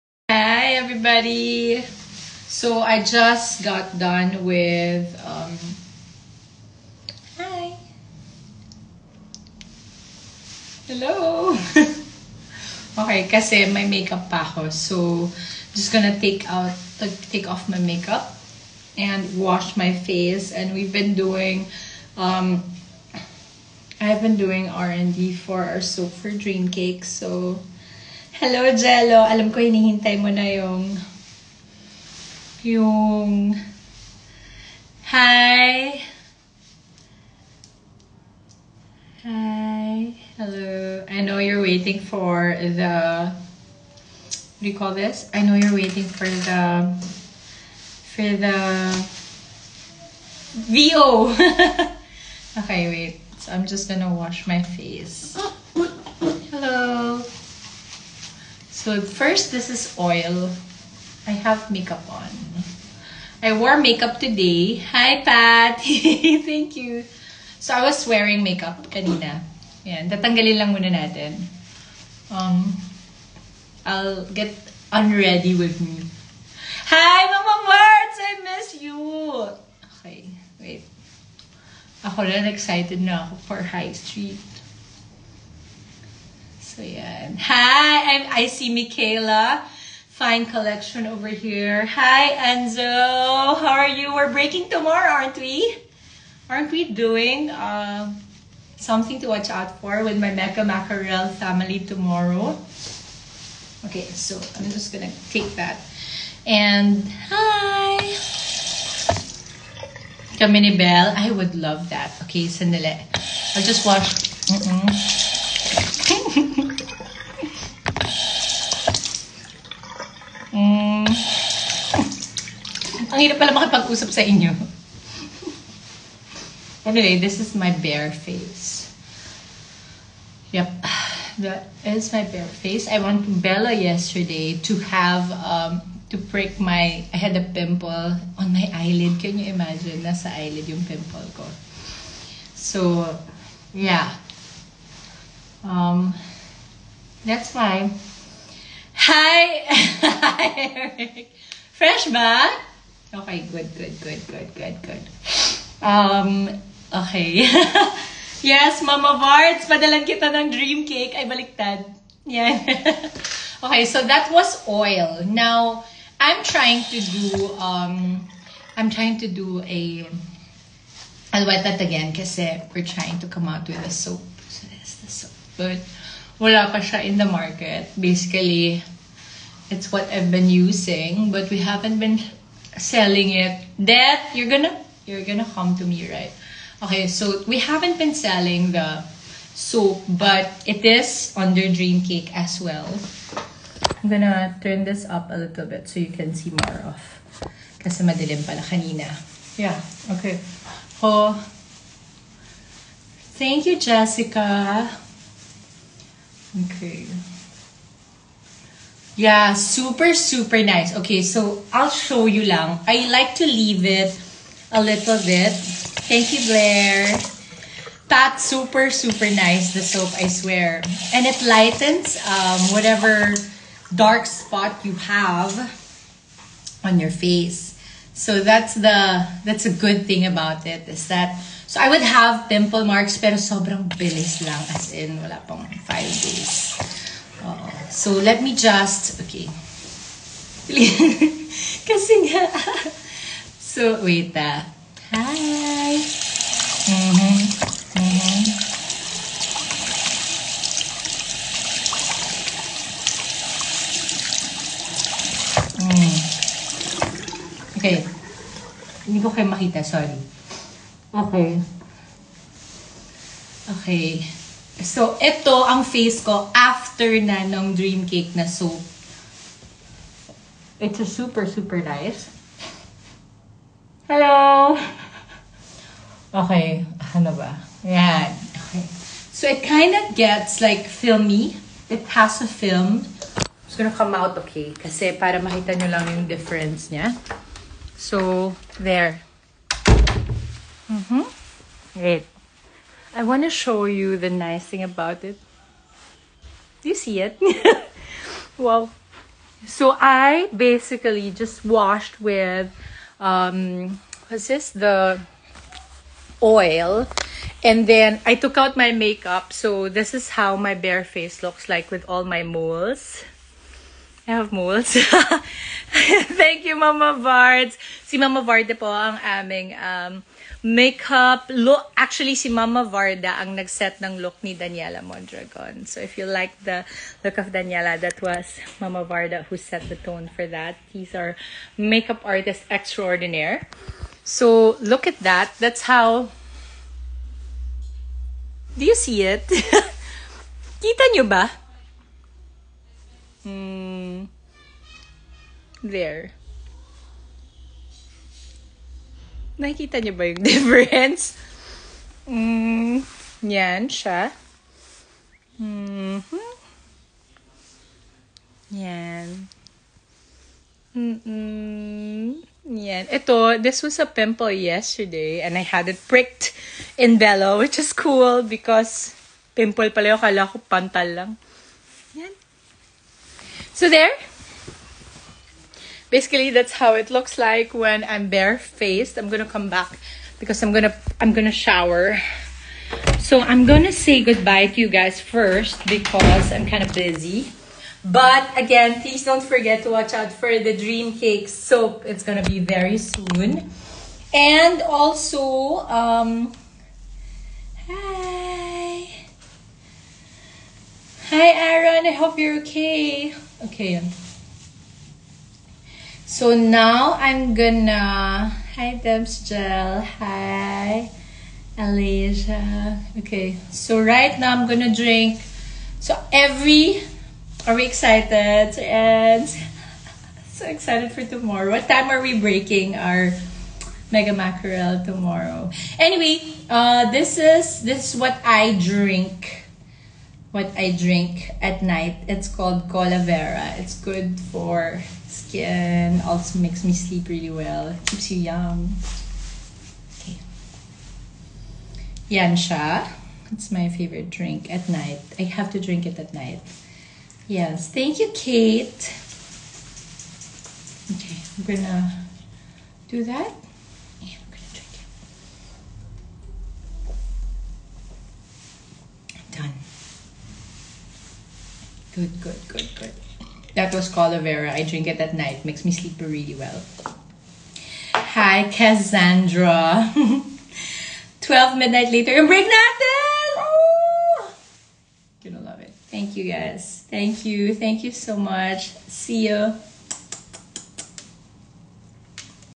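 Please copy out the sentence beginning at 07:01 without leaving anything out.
What time are we breaking our mega mackerel tomorrow?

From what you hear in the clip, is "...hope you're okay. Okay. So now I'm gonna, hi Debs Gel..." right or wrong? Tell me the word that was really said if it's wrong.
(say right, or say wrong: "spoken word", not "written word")
right.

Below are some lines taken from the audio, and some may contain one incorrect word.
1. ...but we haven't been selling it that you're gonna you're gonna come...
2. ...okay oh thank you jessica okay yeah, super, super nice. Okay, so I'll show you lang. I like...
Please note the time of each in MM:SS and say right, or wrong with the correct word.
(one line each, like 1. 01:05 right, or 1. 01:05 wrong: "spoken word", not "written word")
1. 03:01 right
2. 03:20 right.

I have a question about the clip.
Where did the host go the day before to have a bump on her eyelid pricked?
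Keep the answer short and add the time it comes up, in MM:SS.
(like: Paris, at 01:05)
Bella, at 02:13.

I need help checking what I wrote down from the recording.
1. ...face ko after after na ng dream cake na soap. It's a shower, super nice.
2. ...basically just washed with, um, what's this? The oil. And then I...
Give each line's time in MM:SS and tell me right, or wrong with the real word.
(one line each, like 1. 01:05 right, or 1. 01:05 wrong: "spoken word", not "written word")
1. 04:25 wrong: "super", not "shower"
2. 05:00 right.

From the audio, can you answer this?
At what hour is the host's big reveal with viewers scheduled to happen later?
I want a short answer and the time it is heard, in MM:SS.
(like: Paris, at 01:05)
12 midnight, at 07:51.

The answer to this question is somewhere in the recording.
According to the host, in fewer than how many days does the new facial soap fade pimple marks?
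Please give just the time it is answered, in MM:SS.
03:55.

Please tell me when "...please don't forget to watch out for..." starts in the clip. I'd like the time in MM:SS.
06:29.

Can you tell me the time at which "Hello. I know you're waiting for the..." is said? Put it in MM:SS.
00:40.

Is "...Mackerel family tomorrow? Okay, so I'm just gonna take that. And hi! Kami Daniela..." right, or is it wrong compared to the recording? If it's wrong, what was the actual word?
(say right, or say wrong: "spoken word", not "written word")
wrong: "Bell", not "Daniela".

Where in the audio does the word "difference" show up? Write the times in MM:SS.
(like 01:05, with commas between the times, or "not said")
04:46, 05:50.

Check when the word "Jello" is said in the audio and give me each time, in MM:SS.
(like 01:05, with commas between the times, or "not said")
00:28.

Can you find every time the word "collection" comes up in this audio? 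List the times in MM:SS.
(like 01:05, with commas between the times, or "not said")
01:30.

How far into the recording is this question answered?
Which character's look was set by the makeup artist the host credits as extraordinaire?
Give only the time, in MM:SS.
05:24.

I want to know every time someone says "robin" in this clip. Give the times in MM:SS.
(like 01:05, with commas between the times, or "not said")
not said.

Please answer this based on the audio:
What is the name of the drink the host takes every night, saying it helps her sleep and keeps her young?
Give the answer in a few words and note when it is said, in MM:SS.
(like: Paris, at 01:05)
Colavera, at 07:12.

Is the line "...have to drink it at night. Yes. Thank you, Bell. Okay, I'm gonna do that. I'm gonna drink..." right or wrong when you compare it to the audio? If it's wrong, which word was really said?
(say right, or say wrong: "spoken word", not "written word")
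wrong: "Kate", not "Bell".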